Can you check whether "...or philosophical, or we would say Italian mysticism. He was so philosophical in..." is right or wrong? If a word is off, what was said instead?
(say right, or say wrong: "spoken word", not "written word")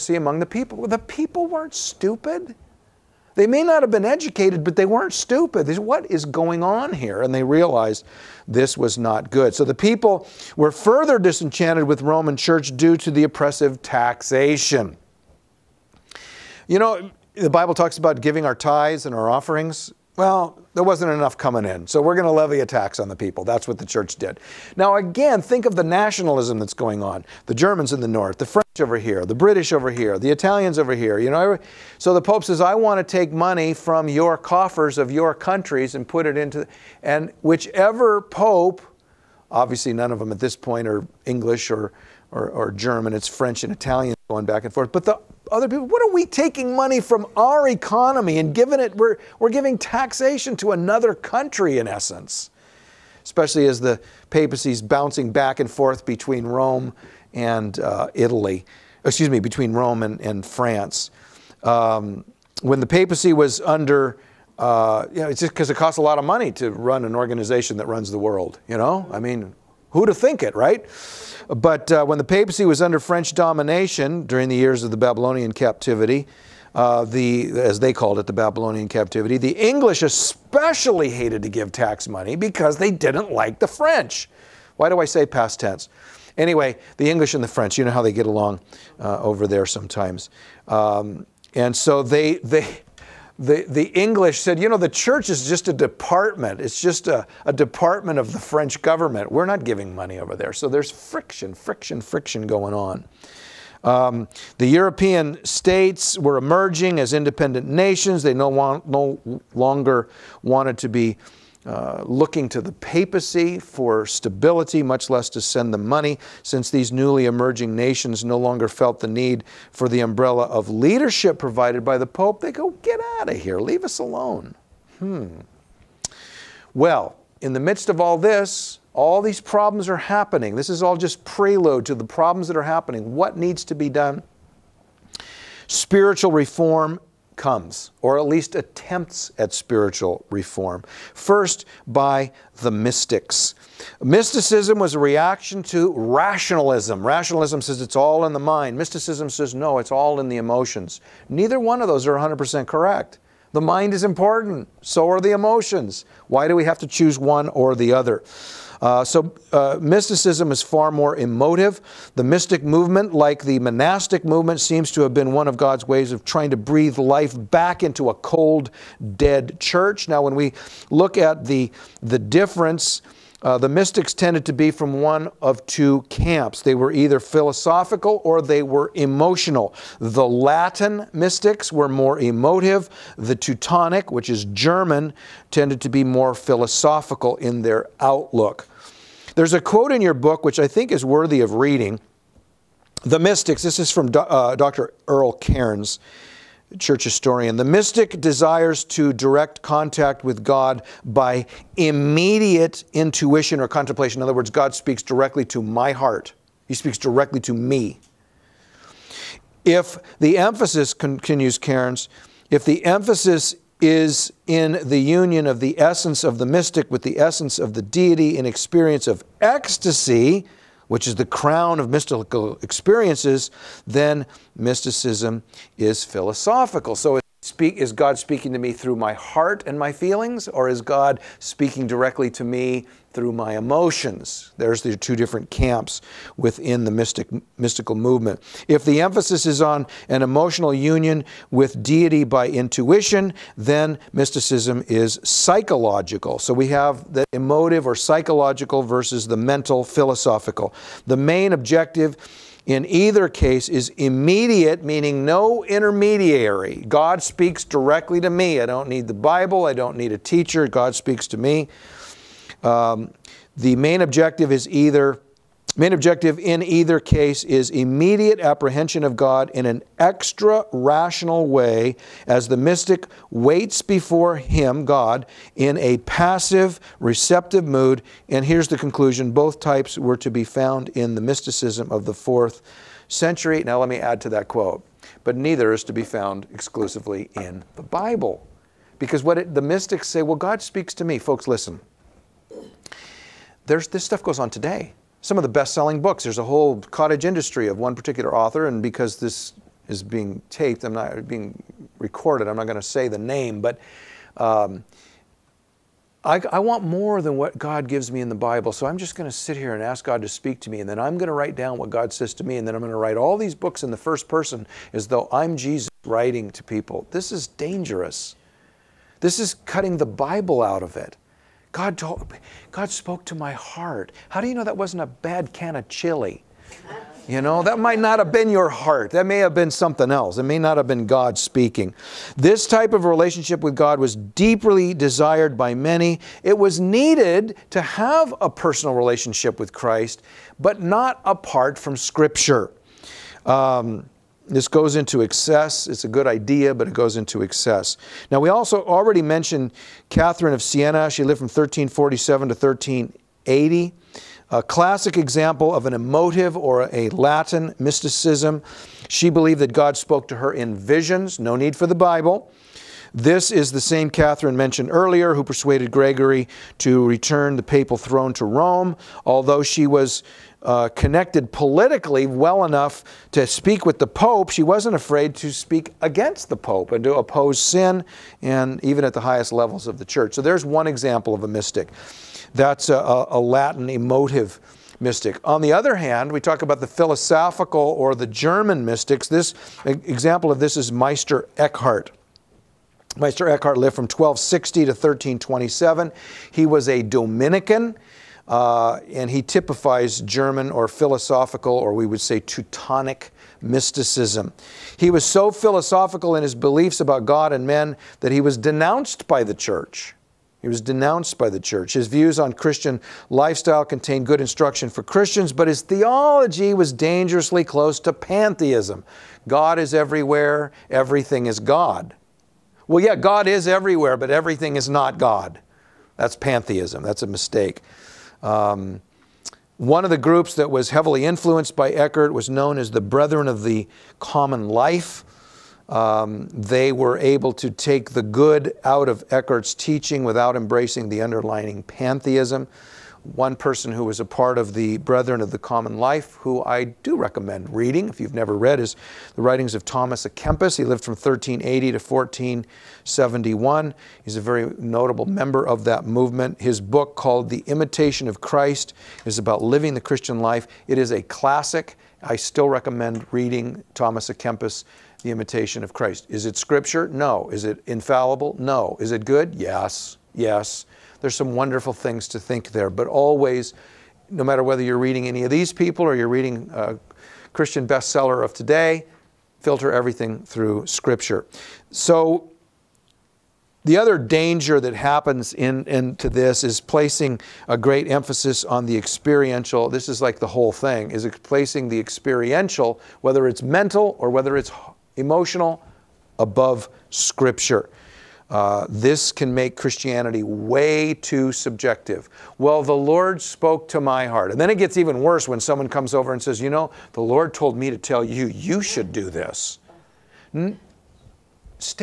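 wrong: "Teutonic", not "Italian".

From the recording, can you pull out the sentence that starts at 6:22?
That's a, a Latin emotive mystic.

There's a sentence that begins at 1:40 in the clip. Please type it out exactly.
So there's friction, friction, friction going on.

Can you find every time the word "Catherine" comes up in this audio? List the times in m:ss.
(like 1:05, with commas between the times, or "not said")
5:50, 6:04.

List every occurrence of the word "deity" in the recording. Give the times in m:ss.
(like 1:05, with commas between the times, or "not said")
3:37, 4:01.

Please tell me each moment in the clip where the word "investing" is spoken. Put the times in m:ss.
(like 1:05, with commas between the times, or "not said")
not said.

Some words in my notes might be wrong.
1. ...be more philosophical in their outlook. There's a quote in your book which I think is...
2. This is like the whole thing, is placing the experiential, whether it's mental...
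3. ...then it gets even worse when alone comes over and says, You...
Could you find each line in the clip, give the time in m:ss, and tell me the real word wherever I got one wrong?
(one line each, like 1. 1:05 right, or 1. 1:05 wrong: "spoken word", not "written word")
1. 3:05 right
2. 8:09 right
3. 8:24 wrong: "someone", not "alone".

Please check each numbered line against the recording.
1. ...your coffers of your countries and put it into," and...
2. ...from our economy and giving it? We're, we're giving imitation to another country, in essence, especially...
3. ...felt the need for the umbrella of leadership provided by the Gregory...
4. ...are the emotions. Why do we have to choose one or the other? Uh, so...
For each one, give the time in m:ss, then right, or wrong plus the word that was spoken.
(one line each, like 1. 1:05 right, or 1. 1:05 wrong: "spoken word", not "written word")
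1. 0:34 right
2. 0:46 wrong: "taxation", not "imitation"
3. 1:58 wrong: "Pope", not "Gregory"
4. 2:35 right.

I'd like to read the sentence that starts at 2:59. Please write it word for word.
The Latin mystics were more emotive.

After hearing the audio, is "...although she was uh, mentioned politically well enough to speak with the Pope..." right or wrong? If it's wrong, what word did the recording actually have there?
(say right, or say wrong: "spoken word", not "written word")
wrong: "connected", not "mentioned".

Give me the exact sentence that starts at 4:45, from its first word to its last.
But neither is to be found exclusively in the Bible.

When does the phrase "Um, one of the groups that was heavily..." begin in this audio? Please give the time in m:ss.
7:08.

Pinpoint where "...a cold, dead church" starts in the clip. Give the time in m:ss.
2:48.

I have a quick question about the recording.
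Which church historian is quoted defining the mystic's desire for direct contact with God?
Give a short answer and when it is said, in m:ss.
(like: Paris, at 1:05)
Earle Cairns, at 3:14.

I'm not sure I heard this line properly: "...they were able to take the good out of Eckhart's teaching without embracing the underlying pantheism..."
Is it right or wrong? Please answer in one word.
right.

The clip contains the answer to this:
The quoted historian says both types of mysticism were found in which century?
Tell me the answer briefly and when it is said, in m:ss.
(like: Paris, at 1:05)
the fourth century, at 4:42.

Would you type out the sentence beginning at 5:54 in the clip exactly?
A classic example of an emotive or a Latin mysticism.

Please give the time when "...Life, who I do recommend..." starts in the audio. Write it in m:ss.
7:25.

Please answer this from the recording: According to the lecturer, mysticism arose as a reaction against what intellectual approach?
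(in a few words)
Rationalism.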